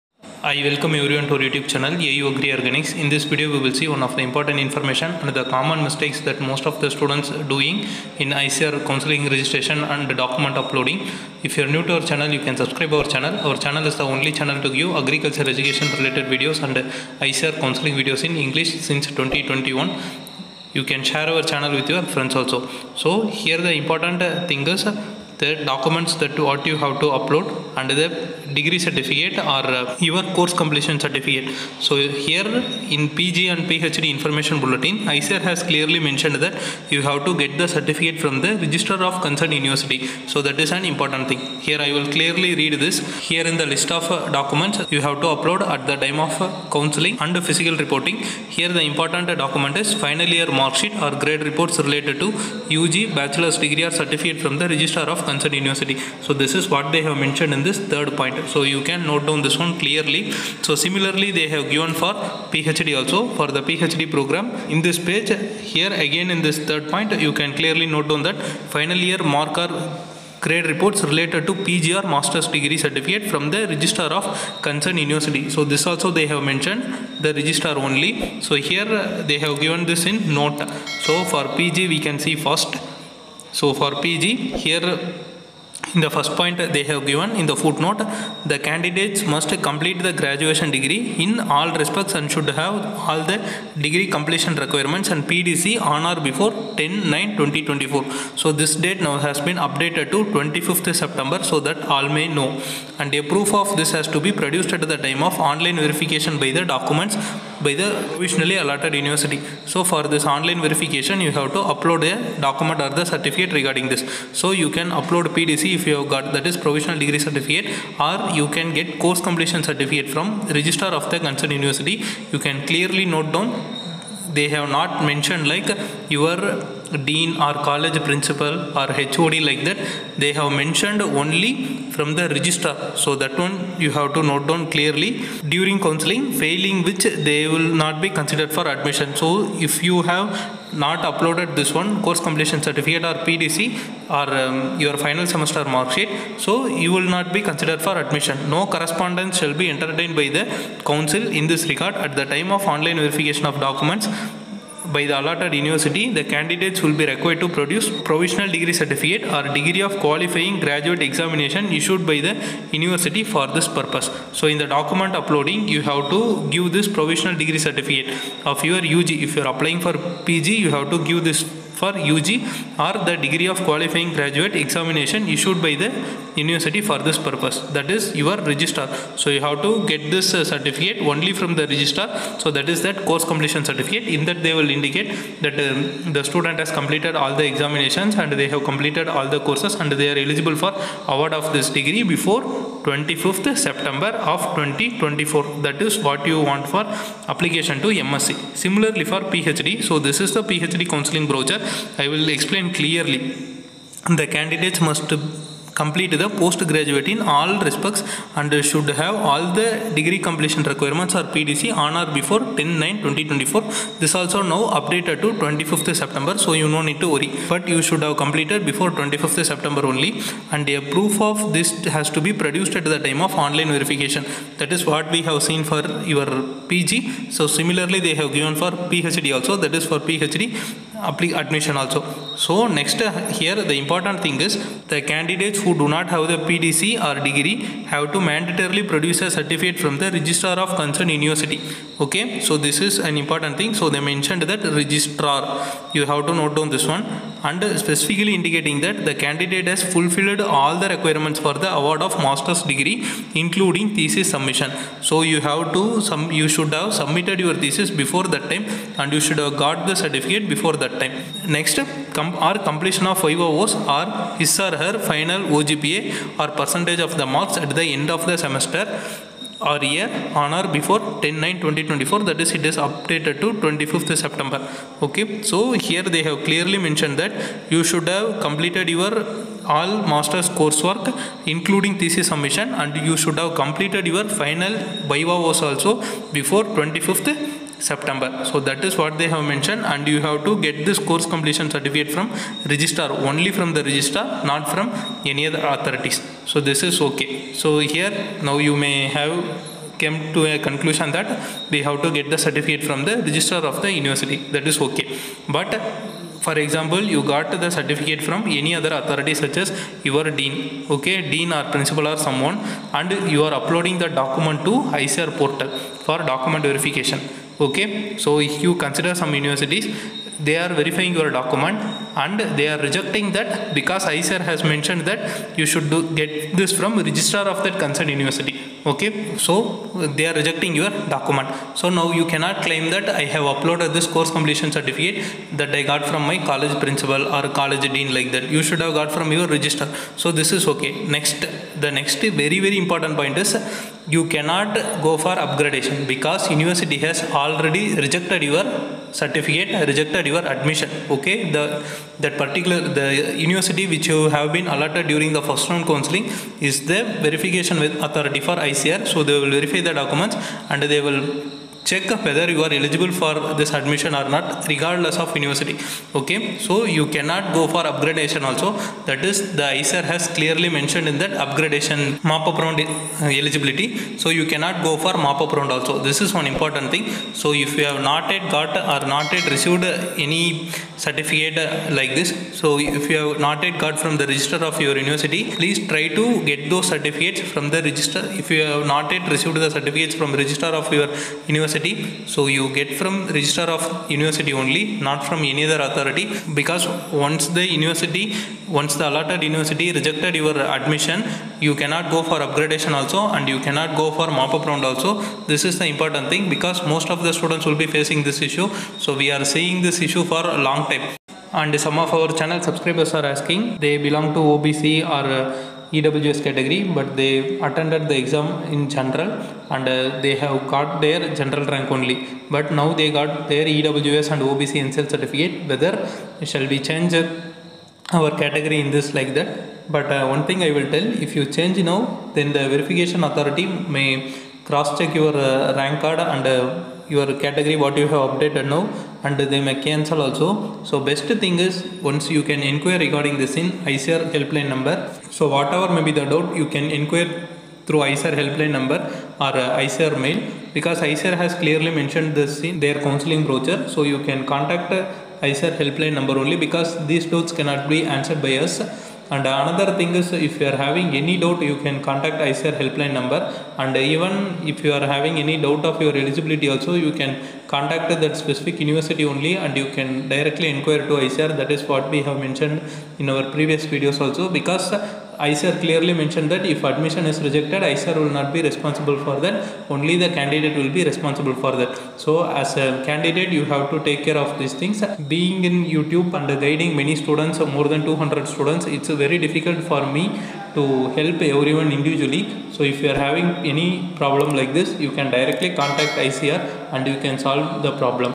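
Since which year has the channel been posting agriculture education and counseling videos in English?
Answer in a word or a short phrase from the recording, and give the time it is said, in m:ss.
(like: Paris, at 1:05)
2021, at 0:19.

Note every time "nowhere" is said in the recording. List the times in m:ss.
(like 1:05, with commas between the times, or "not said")
not said.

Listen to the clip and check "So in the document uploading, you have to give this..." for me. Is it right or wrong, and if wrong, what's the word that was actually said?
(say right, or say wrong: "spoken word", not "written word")
right.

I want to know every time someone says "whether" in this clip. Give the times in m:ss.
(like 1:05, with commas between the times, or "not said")
6:02, 7:05.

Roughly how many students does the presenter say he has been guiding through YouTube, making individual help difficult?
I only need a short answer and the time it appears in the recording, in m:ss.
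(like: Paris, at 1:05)
More than 200, at 8:07.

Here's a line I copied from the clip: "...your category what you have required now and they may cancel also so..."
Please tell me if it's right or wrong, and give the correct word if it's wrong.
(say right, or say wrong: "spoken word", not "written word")
wrong: "updated", not "required".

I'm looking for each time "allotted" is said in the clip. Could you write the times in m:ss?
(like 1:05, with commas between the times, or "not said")
1:48, 2:35, 6:39.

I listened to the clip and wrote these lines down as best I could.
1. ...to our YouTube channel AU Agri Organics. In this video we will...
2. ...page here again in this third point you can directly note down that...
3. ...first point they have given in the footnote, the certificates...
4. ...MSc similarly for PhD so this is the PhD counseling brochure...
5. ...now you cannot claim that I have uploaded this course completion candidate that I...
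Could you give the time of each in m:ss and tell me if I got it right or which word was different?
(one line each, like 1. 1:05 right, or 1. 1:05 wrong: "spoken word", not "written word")
1. 0:01 right
2. 1:05 wrong: "clearly", not "directly"
3. 1:26 wrong: "candidates", not "certificates"
4. 3:18 right
5. 5:31 wrong: "certificate", not "candidate".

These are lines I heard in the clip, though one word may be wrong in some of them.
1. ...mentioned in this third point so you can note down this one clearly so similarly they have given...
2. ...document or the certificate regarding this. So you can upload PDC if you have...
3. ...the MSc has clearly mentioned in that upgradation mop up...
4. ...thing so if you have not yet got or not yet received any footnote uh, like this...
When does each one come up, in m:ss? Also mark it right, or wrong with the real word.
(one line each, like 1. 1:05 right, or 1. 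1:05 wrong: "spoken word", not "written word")
1. 0:57 right
2. 1:52 right
3. 6:09 wrong: "ICAR", not "MSc"
4. 6:16 wrong: "certificate", not "footnote".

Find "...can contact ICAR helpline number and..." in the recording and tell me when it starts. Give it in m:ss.
7:41.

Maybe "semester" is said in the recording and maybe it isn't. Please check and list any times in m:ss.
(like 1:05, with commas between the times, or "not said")
2:25, 4:28.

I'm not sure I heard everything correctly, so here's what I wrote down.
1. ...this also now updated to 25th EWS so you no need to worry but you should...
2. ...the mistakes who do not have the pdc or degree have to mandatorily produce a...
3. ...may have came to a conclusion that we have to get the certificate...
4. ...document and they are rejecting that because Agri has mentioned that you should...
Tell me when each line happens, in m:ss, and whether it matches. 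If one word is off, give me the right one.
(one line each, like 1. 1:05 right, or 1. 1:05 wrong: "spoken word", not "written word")
1. 3:34 wrong: "September", not "EWS"
2. 3:54 wrong: "candidates", not "mistakes"
3. 4:58 right
4. 5:21 wrong: "ICAR", not "Agri".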